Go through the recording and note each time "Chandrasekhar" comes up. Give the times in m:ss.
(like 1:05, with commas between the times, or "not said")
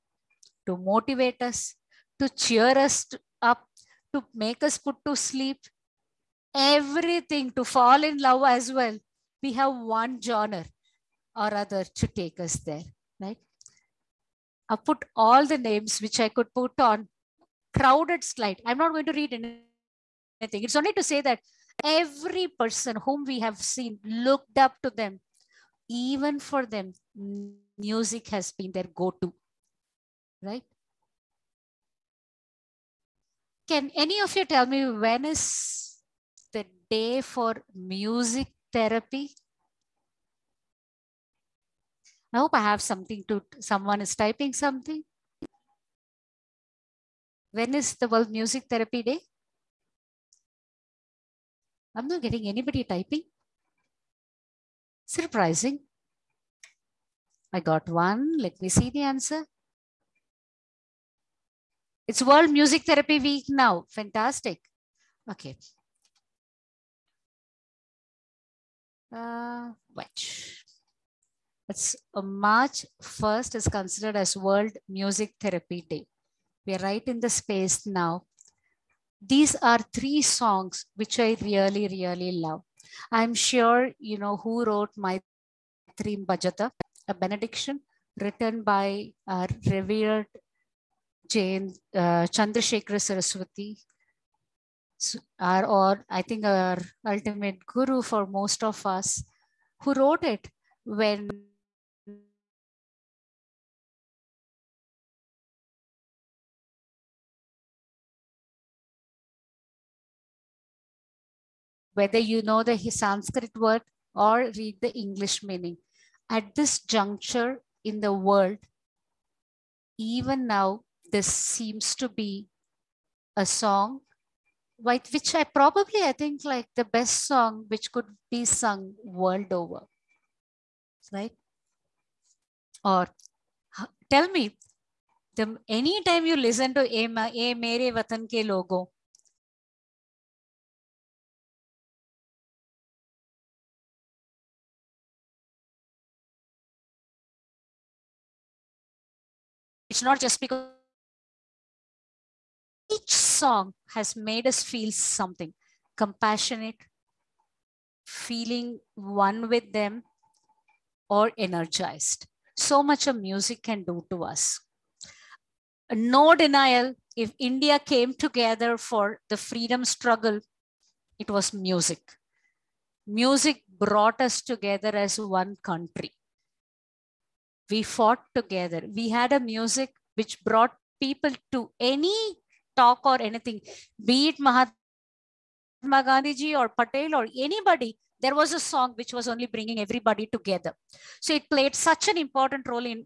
1:32.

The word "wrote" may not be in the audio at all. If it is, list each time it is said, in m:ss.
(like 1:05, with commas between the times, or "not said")
1:24, 1:39.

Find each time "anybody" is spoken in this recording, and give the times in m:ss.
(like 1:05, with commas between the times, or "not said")
0:52, 3:07.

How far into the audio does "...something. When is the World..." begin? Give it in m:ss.
0:44.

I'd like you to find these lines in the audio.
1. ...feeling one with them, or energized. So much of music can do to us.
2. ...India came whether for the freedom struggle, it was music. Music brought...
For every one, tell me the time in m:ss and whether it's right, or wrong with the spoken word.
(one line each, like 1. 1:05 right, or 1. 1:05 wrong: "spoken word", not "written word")
1. 2:38 right
2. 2:47 wrong: "together", not "whether".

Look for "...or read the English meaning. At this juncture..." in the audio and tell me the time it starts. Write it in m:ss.
1:54.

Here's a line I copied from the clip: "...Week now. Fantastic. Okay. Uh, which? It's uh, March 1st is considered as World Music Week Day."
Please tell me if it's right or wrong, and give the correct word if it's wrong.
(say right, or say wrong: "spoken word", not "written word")
wrong: "Therapy", not "Week".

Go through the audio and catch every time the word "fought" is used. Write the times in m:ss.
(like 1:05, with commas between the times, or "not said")
2:57.